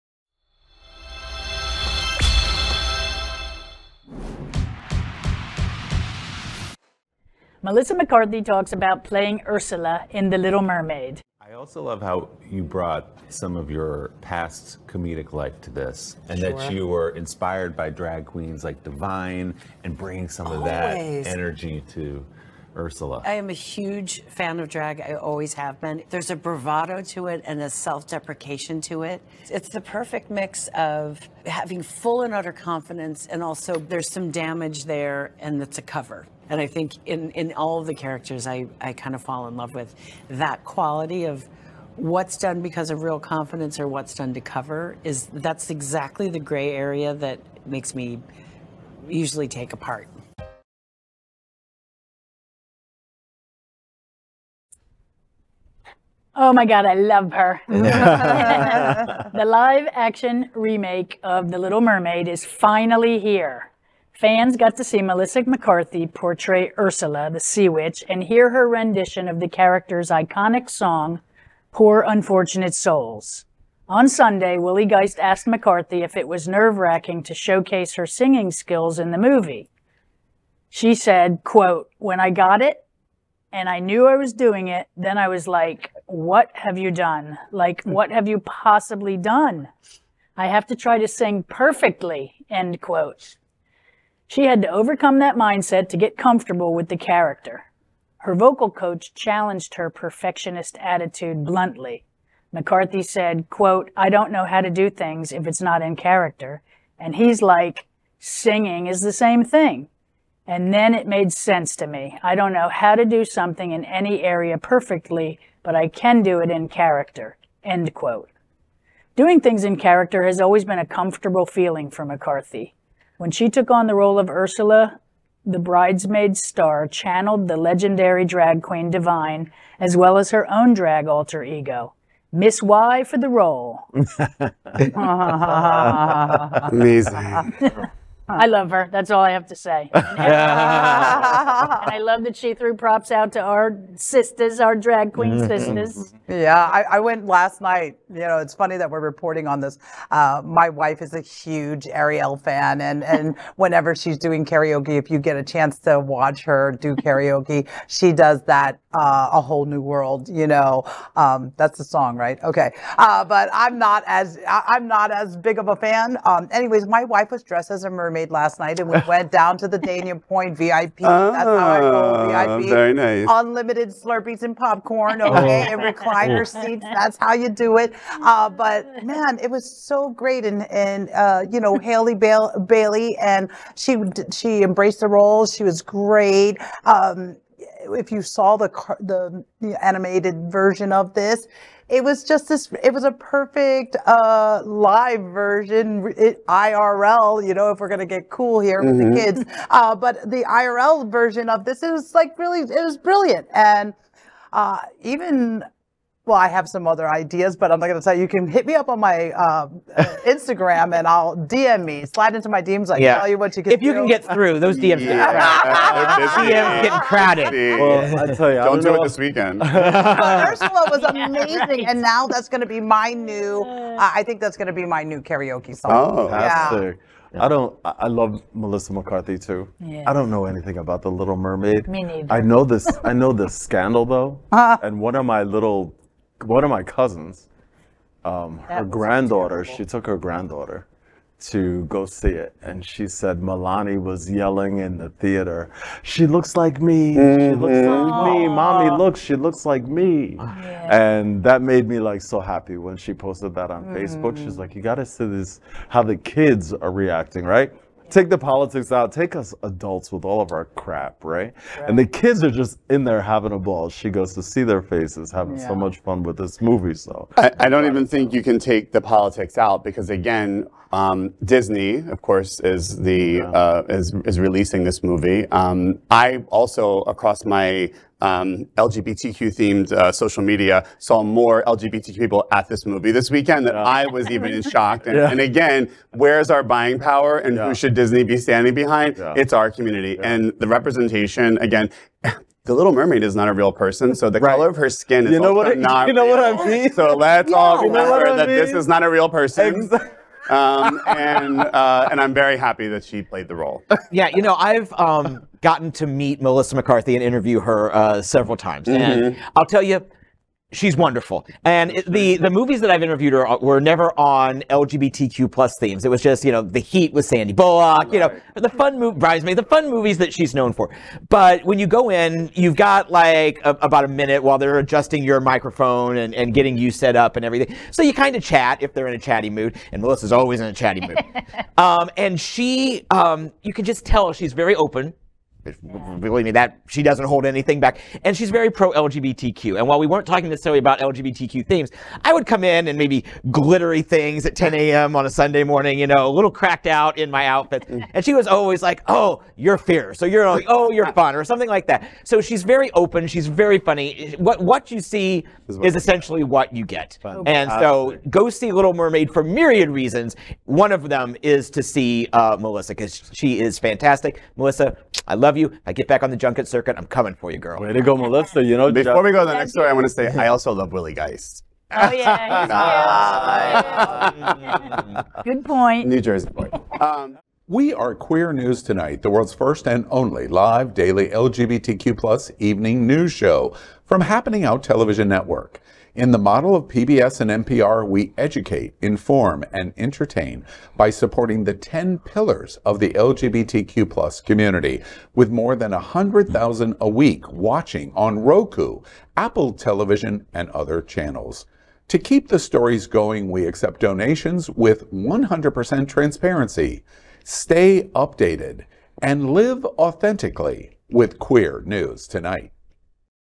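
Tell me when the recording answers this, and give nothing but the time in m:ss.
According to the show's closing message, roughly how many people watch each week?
6:35.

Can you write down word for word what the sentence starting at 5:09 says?
and I'll tell you, She's wonderful.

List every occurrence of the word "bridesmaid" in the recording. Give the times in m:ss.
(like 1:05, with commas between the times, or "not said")
2:05, 5:19.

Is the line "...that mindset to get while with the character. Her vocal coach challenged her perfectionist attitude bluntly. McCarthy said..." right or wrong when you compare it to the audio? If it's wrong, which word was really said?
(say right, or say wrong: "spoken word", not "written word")
wrong: "comfortable", not "while".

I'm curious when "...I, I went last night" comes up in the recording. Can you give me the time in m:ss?
2:26.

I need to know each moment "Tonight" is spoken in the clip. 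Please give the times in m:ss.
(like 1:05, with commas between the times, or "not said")
6:18, 6:52.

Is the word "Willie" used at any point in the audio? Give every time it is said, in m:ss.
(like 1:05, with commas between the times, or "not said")
1:14, 6:10.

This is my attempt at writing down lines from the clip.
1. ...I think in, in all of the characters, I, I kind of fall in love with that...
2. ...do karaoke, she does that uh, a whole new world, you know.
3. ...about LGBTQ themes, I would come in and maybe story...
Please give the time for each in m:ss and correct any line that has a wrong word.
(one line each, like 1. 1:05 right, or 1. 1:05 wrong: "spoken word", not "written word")
1. 0:36 right
2. 2:36 right
3. 5:40 wrong: "glittery", not "story".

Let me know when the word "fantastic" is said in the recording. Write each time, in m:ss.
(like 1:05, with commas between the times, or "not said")
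3:46, 6:03.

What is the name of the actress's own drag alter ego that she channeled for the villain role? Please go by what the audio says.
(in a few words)
Miss Y.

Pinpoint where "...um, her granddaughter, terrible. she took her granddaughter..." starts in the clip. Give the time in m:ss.
3:58.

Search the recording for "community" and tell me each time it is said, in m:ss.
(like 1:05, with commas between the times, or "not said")
4:49, 6:34.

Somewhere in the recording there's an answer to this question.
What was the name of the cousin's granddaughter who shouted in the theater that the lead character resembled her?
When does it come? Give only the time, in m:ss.
4:03.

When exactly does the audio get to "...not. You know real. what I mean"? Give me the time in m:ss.
4:55.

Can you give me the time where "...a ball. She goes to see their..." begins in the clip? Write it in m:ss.
4:23.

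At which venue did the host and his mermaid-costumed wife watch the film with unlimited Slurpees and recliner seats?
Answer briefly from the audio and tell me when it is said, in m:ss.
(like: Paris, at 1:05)
Dania Pointe, at 2:49.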